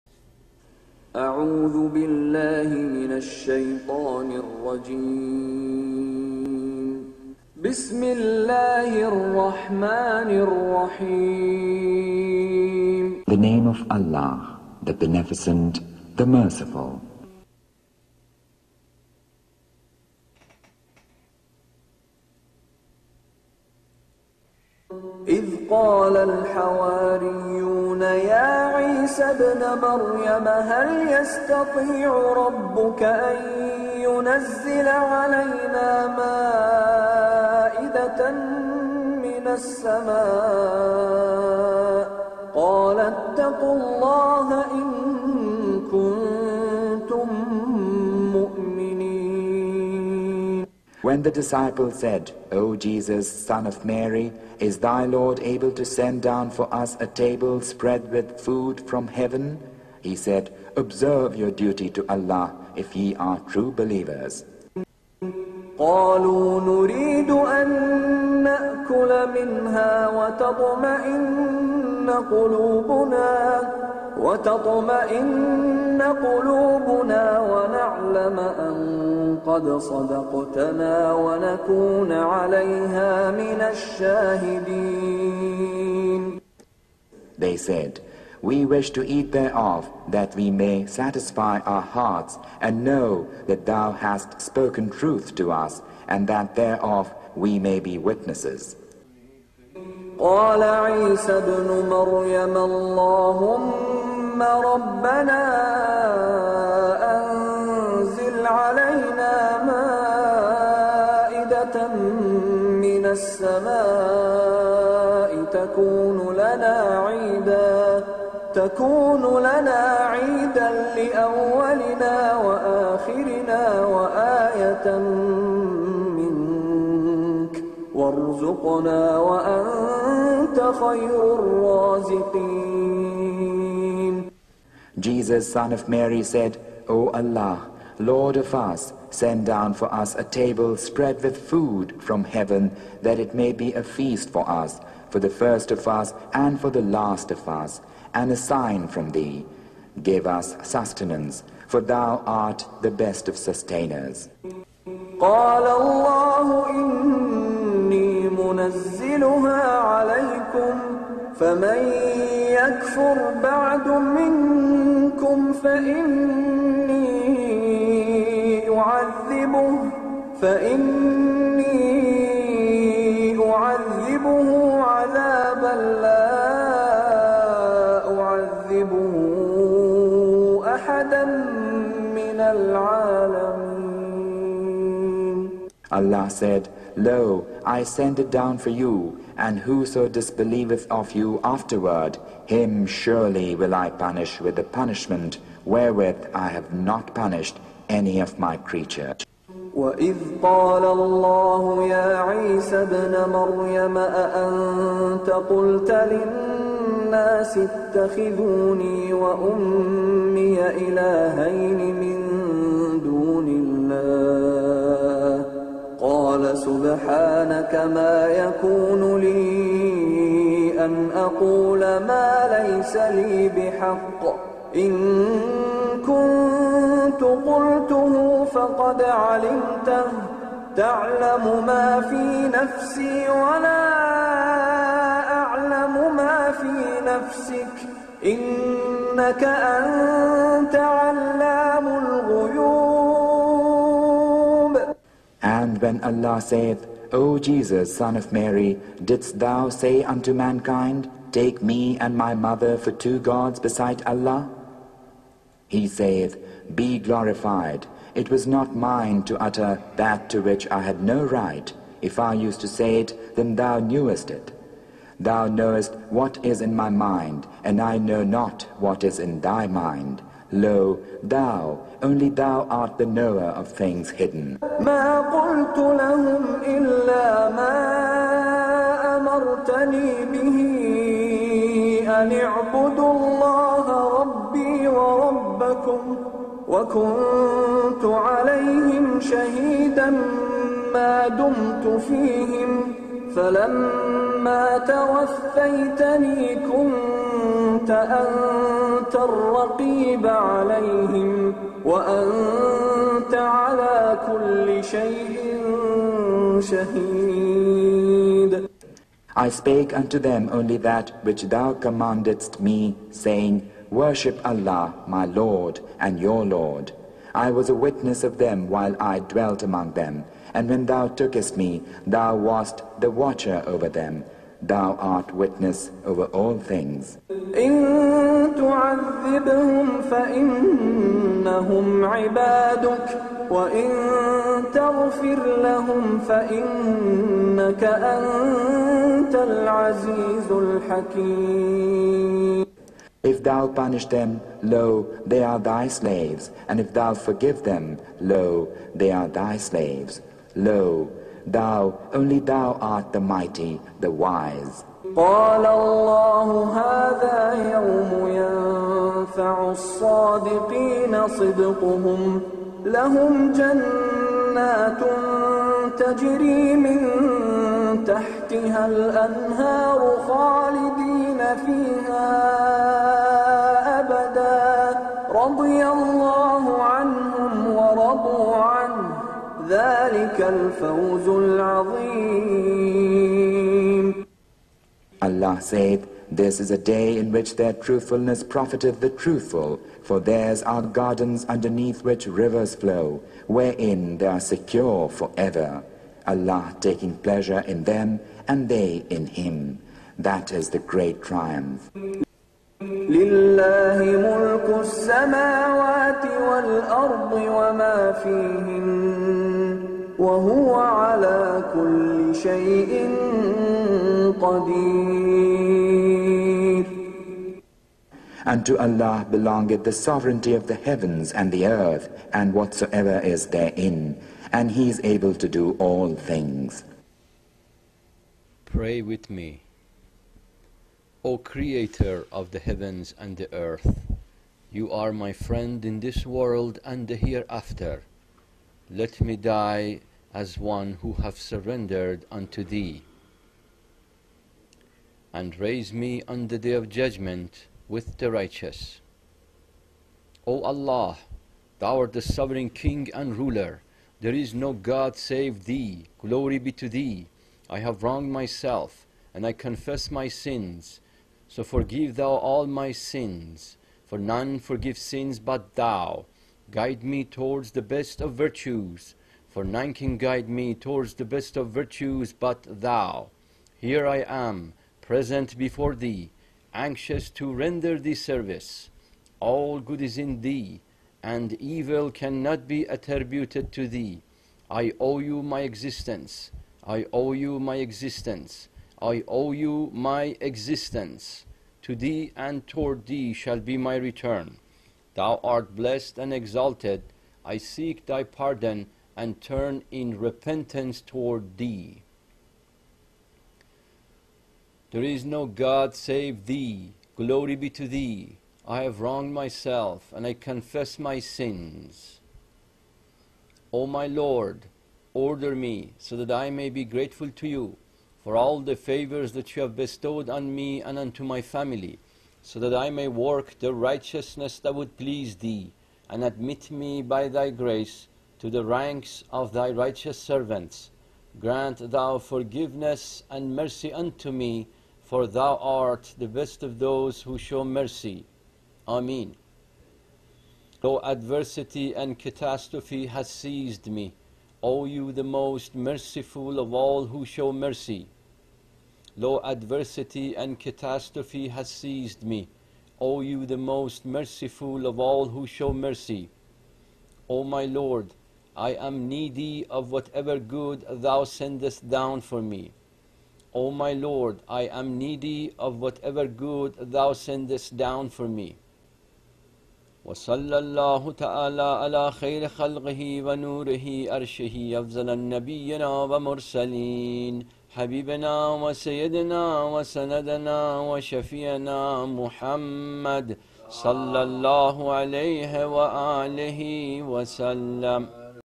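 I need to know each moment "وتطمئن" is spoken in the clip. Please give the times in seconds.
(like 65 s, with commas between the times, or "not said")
70 s, 74 s.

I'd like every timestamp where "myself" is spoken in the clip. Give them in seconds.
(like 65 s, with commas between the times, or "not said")
458 s, 509 s.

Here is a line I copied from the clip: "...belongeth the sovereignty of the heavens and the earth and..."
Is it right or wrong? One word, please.
right.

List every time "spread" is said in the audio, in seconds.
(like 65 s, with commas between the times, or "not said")
57 s, 140 s.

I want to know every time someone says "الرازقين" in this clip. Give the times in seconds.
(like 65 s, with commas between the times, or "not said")
131 s.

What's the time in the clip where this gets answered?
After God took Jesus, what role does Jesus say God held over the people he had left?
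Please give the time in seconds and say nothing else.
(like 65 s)
322 s.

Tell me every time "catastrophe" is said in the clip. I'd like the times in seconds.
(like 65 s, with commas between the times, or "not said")
542 s, 550 s.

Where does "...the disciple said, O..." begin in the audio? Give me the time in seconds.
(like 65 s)
51 s.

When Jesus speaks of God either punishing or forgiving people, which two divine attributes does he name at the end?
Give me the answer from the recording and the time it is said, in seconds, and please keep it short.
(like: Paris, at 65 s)
the mighty, the wise, at 353 s.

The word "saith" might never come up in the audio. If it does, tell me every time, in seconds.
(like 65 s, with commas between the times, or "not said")
246 s, 255 s.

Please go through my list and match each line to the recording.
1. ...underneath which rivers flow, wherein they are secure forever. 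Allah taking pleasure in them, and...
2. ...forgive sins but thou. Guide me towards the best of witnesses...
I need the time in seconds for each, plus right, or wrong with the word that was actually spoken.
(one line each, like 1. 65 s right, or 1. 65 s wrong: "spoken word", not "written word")
1. 391 s right
2. 464 s wrong: "virtues", not "witnesses".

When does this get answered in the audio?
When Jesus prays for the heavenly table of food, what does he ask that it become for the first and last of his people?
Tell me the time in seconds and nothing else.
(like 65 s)
143 s.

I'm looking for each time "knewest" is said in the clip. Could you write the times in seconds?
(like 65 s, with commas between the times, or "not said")
263 s.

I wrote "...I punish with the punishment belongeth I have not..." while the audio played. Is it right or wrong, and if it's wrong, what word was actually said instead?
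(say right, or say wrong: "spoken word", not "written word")
wrong: "wherewith", not "belongeth".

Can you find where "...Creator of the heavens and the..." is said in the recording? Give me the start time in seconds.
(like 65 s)
431 s.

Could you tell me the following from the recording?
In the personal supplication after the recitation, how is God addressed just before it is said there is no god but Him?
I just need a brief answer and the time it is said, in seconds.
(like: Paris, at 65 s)
sovereign king and ruler, at 452 s.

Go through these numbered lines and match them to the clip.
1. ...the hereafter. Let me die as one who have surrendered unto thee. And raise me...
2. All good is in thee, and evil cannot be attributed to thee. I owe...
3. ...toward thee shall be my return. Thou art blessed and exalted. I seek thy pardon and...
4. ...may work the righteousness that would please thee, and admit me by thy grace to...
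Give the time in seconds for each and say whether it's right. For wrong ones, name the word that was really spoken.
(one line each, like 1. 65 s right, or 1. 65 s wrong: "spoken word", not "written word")
1. 437 s right
2. 479 s right
3. 492 s right
4. 522 s right.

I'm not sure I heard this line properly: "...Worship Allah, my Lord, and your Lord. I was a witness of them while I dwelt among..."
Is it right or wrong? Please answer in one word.
right.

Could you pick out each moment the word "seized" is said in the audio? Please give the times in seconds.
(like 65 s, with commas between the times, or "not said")
543 s, 551 s.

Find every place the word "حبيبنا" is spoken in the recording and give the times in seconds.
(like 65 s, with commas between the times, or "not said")
577 s.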